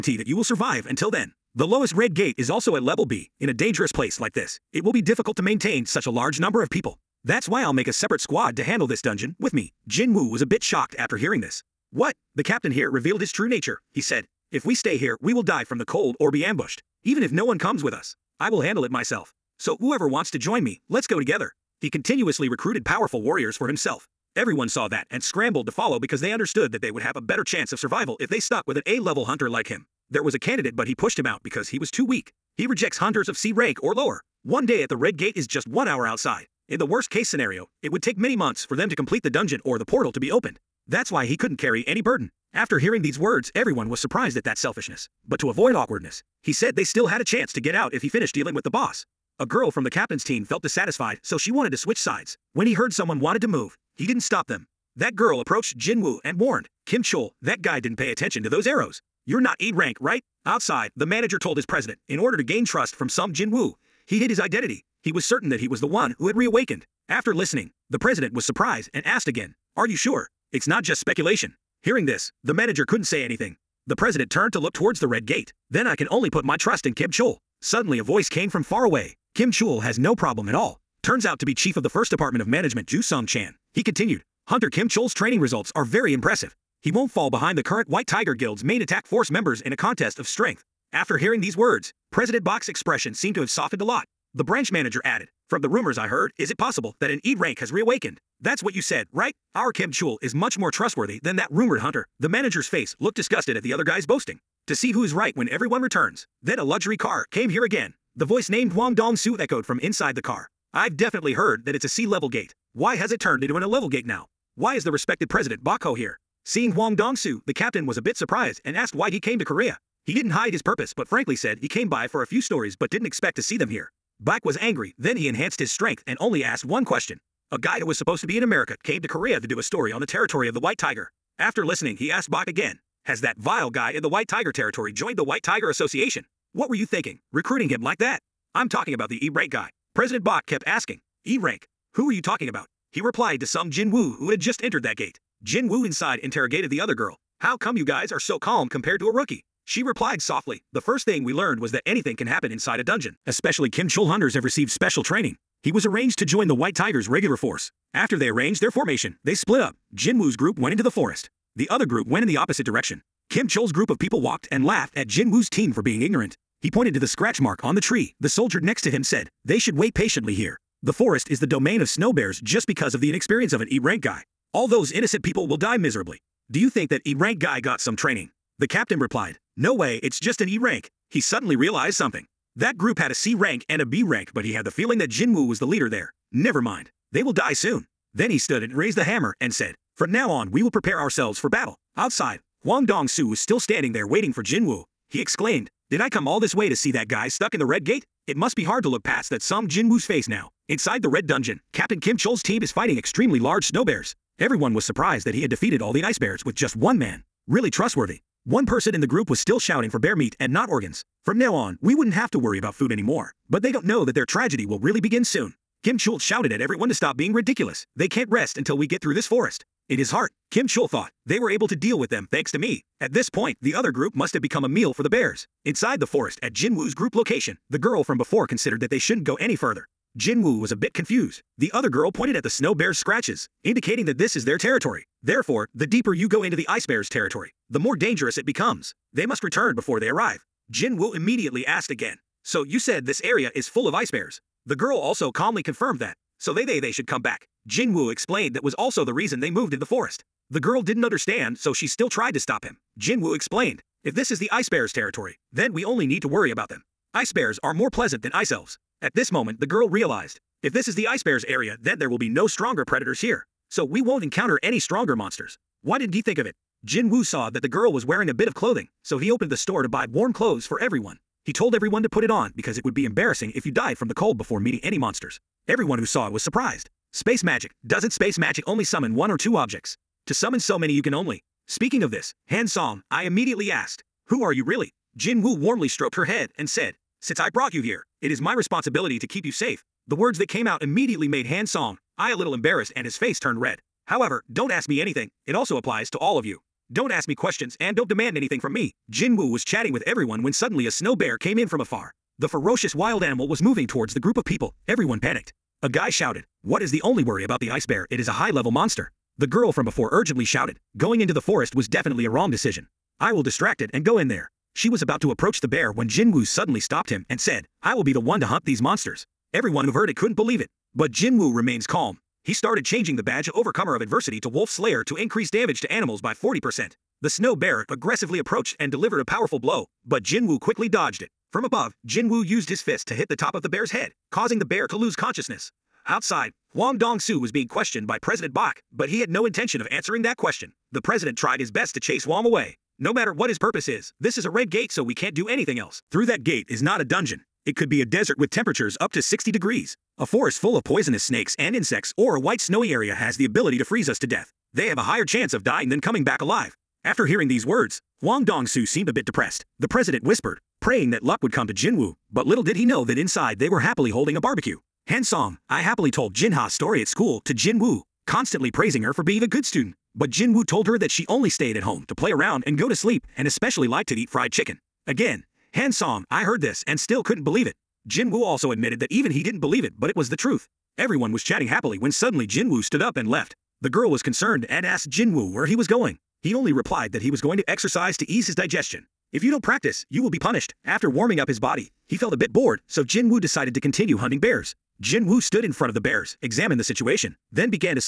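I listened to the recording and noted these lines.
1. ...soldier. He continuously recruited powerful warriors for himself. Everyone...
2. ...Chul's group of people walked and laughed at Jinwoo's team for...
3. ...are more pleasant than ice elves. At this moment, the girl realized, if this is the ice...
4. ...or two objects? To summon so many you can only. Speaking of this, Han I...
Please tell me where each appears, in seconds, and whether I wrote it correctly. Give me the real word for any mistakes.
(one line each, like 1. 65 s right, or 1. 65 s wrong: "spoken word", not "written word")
1. 21 s wrong: "together", not "soldier"
2. 163 s right
3. 257 s right
4. 279 s right.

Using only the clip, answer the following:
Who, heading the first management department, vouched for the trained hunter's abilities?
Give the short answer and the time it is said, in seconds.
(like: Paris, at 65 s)
Ju Sung Chan, at 82 s.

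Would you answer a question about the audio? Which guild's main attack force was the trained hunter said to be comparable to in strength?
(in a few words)
White Tiger Guild.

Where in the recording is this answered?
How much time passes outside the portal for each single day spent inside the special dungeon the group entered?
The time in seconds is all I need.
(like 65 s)
35 s.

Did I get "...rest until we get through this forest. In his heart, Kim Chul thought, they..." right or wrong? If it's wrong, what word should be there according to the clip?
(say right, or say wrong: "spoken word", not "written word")
right.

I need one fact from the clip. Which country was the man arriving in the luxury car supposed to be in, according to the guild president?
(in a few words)
America.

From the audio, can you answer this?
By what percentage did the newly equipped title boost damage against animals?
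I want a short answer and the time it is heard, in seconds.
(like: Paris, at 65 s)
40%, at 326 s.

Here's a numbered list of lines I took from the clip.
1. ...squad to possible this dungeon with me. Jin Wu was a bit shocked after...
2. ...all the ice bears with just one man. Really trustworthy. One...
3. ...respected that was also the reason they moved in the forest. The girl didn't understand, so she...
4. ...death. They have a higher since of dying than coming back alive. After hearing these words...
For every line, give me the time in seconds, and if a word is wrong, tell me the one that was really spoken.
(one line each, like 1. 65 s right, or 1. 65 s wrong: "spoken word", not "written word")
1. 8 s wrong: "handle", not "possible"
2. 205 s right
3. 248 s wrong: "explained", not "respected"
4. 354 s wrong: "chance", not "since".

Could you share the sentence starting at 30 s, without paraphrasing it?
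There was a candidate, but he pushed him out because he was too weak.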